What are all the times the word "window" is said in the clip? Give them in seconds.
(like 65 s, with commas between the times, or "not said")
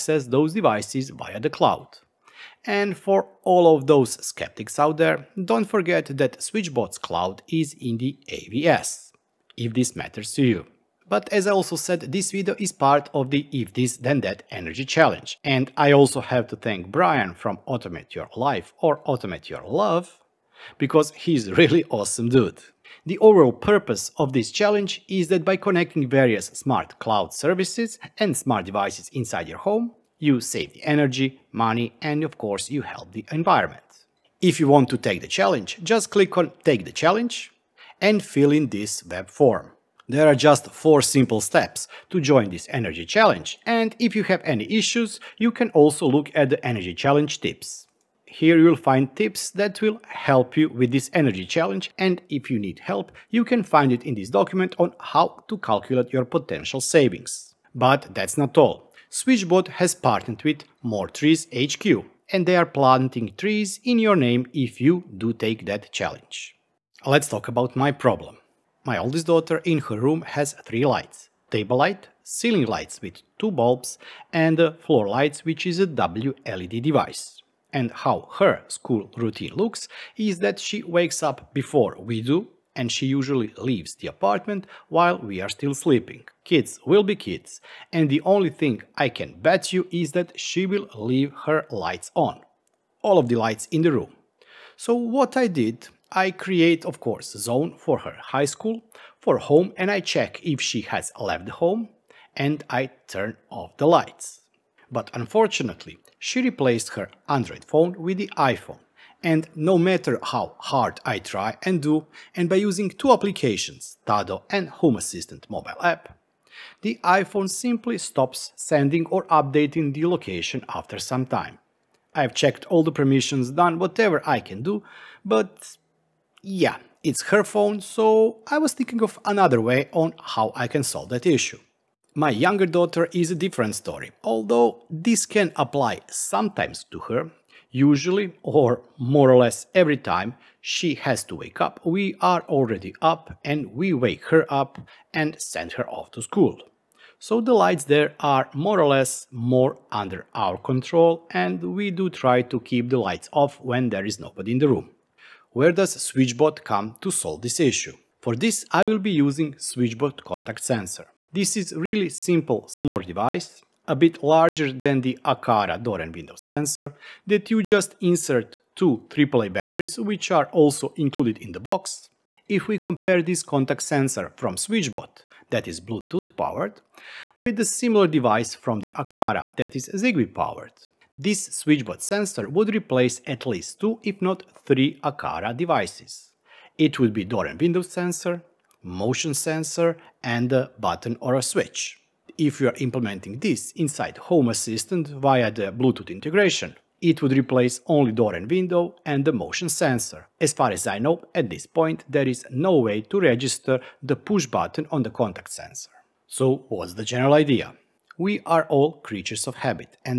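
166 s, 187 s, 198 s.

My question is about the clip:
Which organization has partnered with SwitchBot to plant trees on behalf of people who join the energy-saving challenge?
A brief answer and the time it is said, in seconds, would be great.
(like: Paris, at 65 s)
More Trees HQ, at 60 s.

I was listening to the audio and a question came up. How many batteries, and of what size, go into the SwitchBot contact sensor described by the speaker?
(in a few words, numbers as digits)
2 AAA batteries.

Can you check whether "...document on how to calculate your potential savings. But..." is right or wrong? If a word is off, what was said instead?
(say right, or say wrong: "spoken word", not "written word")
right.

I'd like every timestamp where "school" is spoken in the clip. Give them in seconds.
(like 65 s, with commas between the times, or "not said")
78 s, 98 s, 146 s.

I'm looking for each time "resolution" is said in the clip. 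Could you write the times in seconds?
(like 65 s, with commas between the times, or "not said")
not said.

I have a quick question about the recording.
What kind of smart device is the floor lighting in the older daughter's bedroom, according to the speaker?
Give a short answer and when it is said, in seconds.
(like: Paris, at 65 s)
WLED device, at 75 s.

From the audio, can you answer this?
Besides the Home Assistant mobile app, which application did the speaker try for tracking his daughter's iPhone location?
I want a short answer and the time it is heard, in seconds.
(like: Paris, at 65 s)
Tado, at 114 s.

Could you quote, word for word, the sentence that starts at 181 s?
This SwitchBot sensor would replace at least two, if not three Aqara devices.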